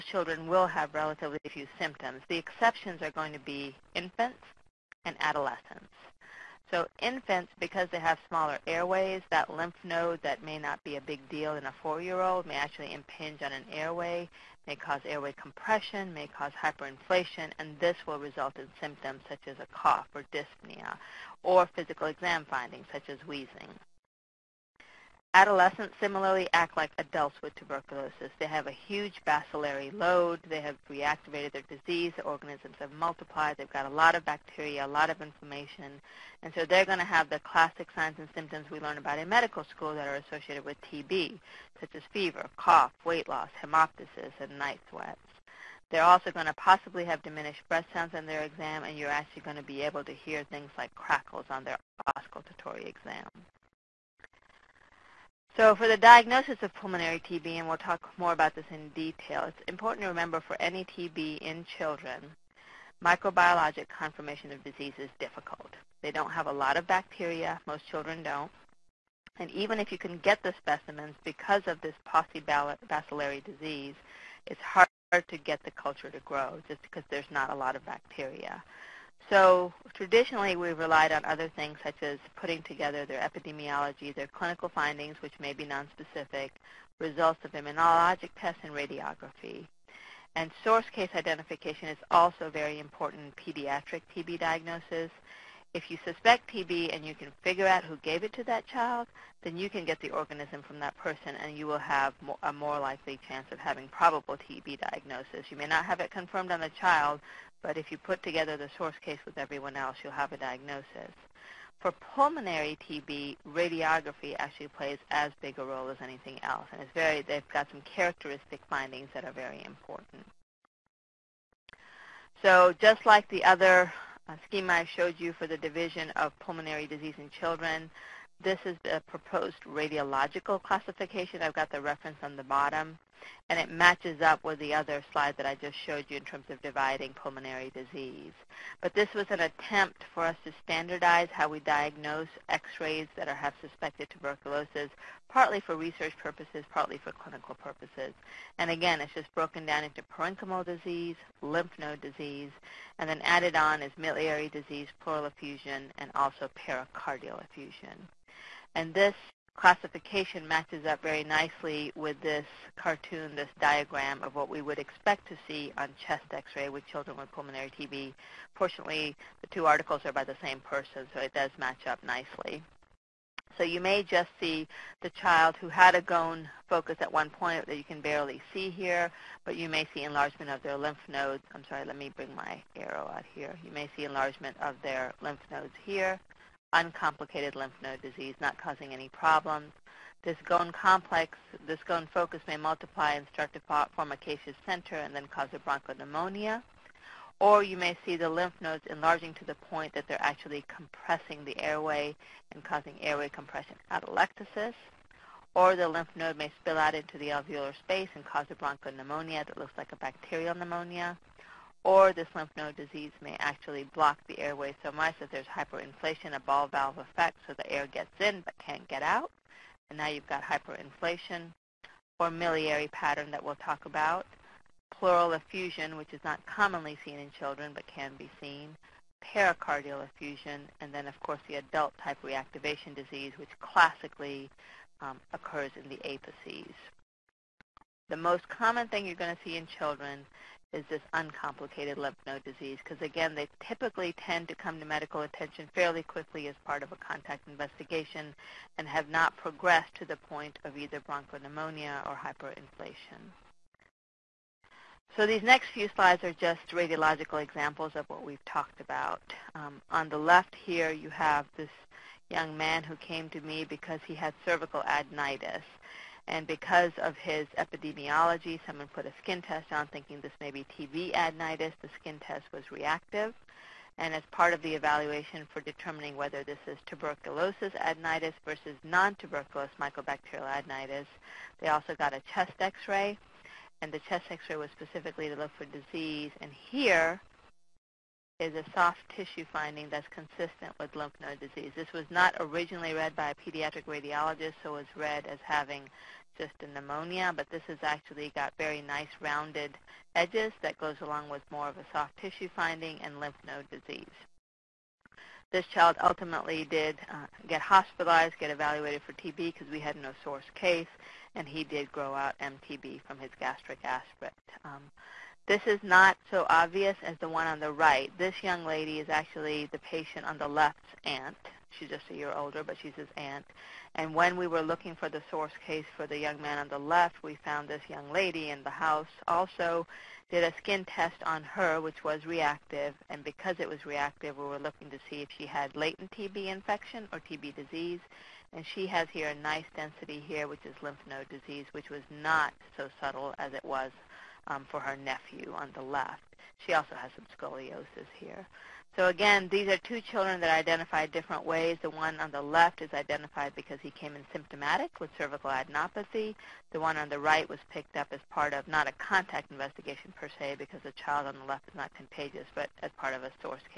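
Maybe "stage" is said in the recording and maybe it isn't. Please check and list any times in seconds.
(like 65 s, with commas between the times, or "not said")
not said.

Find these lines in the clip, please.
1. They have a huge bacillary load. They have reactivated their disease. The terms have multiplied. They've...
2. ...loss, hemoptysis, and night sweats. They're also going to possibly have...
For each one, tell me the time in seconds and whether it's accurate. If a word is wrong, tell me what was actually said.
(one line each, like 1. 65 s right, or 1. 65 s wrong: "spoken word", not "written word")
1. 28 s wrong: "organisms", not "terms"
2. 43 s right.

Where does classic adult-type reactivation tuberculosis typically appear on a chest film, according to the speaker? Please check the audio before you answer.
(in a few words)
The apices.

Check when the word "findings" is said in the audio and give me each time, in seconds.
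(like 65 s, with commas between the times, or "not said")
22 s, 84 s, 118 s, 289 s, 302 s.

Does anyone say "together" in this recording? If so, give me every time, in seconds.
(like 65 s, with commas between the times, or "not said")
82 s, 108 s.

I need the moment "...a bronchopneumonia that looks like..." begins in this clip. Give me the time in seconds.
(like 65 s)
208 s.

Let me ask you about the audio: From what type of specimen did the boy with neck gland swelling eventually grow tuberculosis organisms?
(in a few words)
Gastric aspirate.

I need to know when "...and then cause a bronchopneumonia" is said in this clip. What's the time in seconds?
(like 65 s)
194 s.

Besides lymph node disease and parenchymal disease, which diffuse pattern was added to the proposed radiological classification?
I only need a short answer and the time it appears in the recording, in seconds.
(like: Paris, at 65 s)
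Miliary disease, at 153 s.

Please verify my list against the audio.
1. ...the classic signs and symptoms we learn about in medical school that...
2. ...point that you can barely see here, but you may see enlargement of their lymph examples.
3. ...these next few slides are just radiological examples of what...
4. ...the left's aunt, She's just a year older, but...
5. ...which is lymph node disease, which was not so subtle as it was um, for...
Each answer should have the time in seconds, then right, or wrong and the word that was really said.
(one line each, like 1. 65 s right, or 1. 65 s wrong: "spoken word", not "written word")
1. 37 s right
2. 177 s wrong: "nodes", not "examples"
3. 255 s right
4. 320 s right
5. 340 s right.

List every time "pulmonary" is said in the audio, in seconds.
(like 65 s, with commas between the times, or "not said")
56 s, 111 s, 126 s, 137 s, 167 s.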